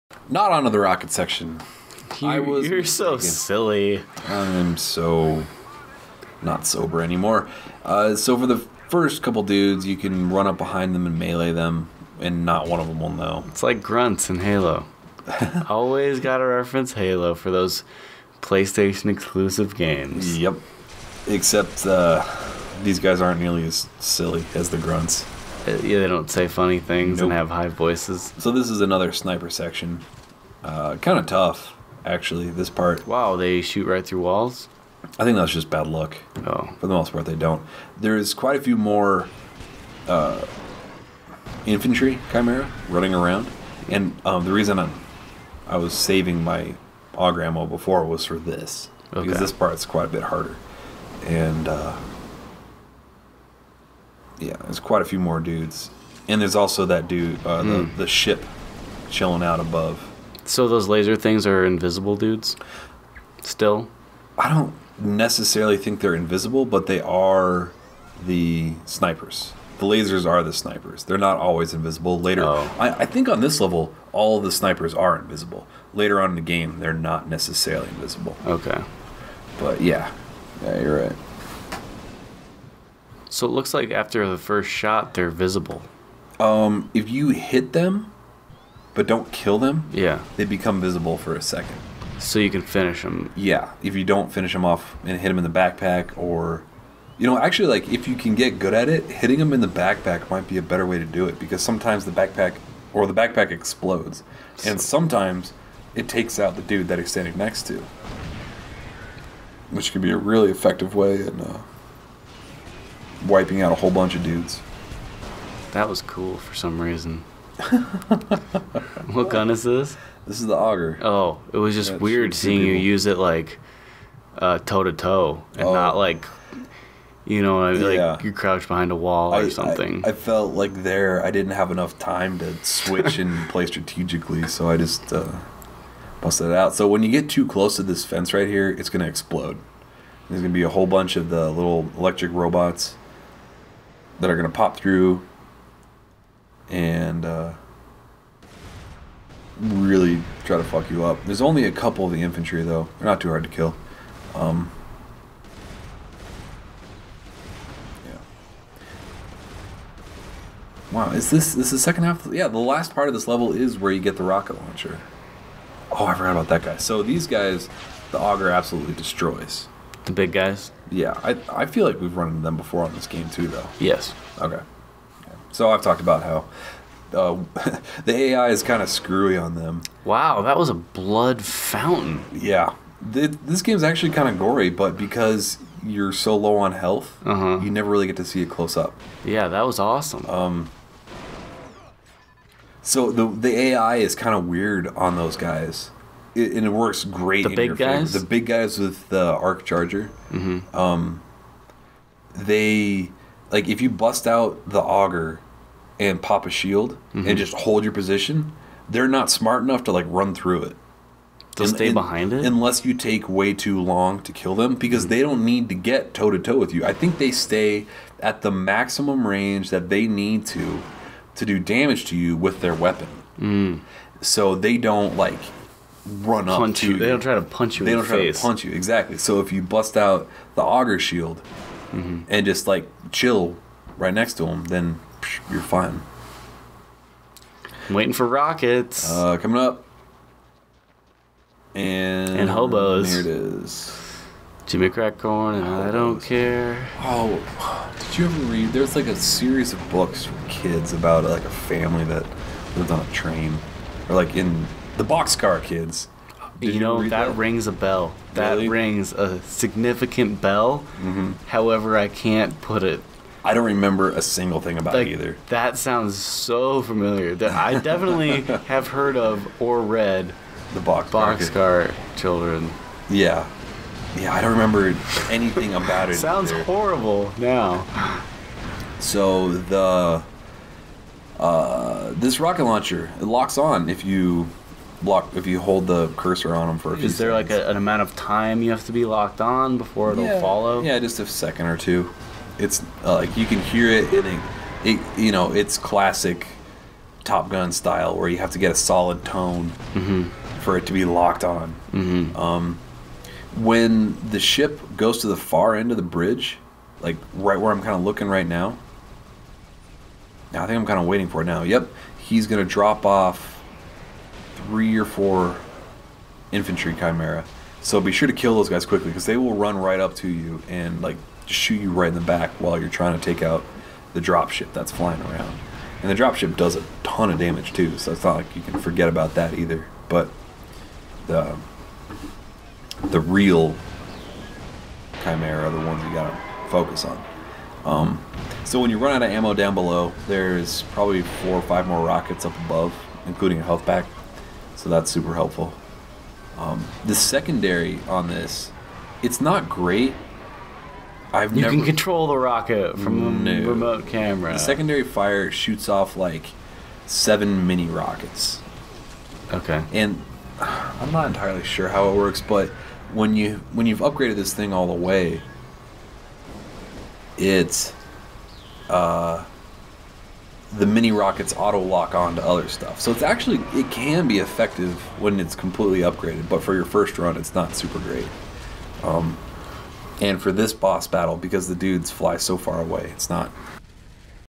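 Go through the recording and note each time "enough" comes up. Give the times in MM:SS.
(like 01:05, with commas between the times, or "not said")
02:11, 03:29.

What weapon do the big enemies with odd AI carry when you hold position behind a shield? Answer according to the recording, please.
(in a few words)
Arc charger.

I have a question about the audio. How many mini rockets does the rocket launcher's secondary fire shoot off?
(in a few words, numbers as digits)
7.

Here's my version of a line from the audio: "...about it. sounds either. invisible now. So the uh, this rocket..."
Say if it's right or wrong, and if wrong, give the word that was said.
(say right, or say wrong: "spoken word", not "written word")
wrong: "horrible", not "invisible".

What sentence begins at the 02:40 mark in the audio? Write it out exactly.
Wow, is this, this the second half?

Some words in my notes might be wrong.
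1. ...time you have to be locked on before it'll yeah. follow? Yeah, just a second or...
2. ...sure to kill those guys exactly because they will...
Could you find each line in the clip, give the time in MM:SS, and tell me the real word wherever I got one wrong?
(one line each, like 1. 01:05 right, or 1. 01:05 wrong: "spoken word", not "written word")
1. 04:48 right
2. 05:18 wrong: "quickly", not "exactly".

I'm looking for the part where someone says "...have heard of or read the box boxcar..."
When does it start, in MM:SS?
04:28.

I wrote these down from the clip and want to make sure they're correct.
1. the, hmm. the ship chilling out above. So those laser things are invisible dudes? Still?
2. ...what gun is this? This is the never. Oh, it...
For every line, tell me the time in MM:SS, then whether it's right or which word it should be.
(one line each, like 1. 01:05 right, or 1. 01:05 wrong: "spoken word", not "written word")
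1. 00:57 right
2. 01:59 wrong: "auger", not "never".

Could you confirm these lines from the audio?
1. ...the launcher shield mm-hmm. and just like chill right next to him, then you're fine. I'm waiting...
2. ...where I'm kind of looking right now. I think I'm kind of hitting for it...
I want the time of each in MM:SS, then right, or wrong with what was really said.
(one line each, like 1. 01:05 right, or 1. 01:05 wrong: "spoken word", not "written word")
1. 03:50 wrong: "auger", not "launcher"
2. 05:07 wrong: "waiting", not "hitting".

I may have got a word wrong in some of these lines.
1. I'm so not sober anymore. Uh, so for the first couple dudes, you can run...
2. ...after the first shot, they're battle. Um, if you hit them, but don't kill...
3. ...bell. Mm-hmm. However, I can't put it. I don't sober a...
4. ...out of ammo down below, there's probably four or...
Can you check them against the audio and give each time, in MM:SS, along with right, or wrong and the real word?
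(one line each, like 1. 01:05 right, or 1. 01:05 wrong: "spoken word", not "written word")
1. 00:04 right
2. 01:23 wrong: "visible", not "battle"
3. 04:20 wrong: "remember", not "sober"
4. 05:39 right.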